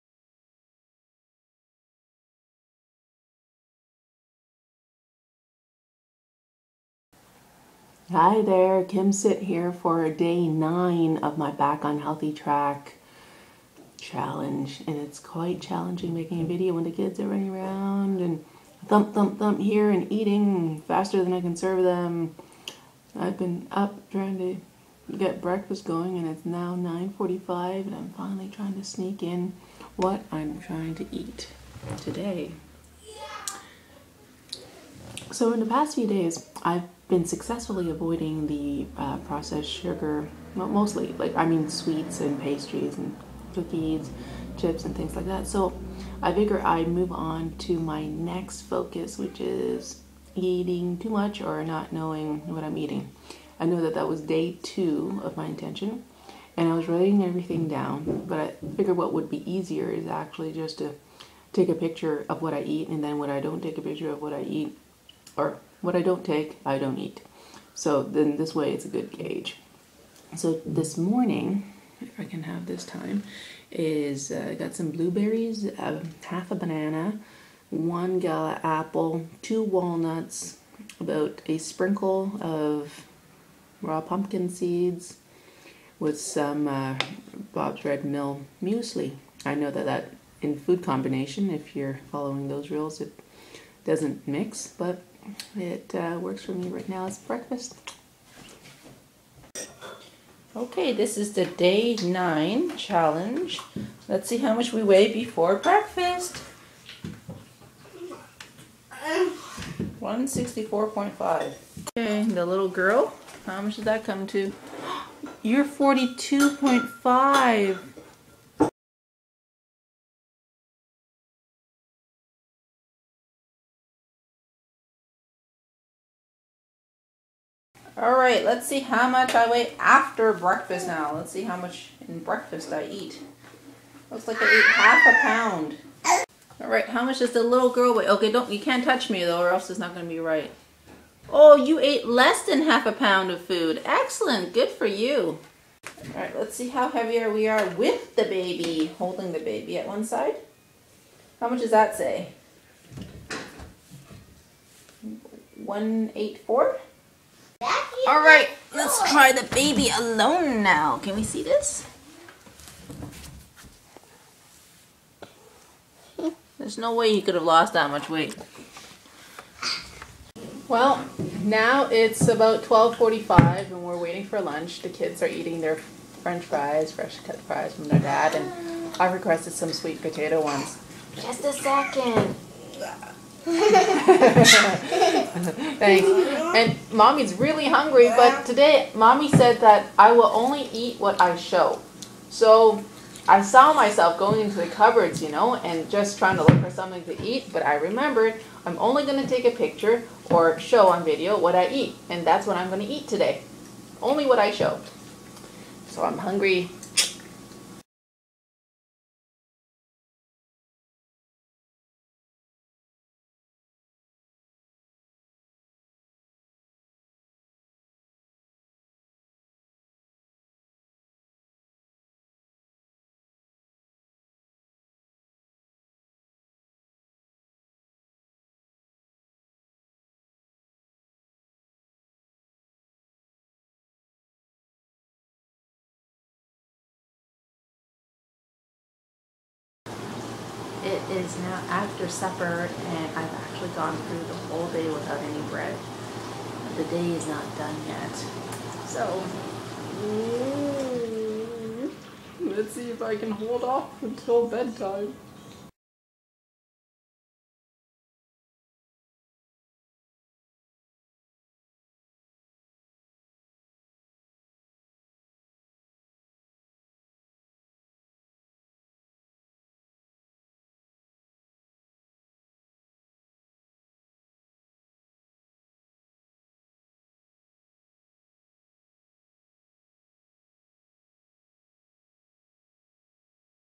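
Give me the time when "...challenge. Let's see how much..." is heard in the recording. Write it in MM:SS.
01:42.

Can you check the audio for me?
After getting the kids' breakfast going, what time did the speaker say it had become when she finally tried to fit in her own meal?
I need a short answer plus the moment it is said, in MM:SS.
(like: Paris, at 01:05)
9:45, at 00:26.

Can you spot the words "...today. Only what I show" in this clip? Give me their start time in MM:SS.
03:23.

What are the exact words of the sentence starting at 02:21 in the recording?
Oh, you ate less than half a pound of food.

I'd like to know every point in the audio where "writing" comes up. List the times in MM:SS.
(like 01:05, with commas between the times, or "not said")
00:56.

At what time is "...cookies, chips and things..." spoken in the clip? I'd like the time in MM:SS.
00:43.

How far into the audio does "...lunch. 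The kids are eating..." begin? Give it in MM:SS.
02:54.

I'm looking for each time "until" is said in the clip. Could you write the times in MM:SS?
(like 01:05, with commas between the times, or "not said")
04:14.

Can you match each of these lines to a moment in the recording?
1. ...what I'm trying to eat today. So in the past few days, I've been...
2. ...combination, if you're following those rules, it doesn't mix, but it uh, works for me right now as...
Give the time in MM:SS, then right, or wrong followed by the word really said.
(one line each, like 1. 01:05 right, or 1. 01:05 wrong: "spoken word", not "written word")
1. 00:29 right
2. 01:30 right.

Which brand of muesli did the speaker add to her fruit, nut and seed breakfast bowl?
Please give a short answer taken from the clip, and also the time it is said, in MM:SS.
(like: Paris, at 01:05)
Bob's Red Mill, at 01:27.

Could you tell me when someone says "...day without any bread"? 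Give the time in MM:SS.
04:04.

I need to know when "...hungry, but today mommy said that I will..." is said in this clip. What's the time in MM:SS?
03:07.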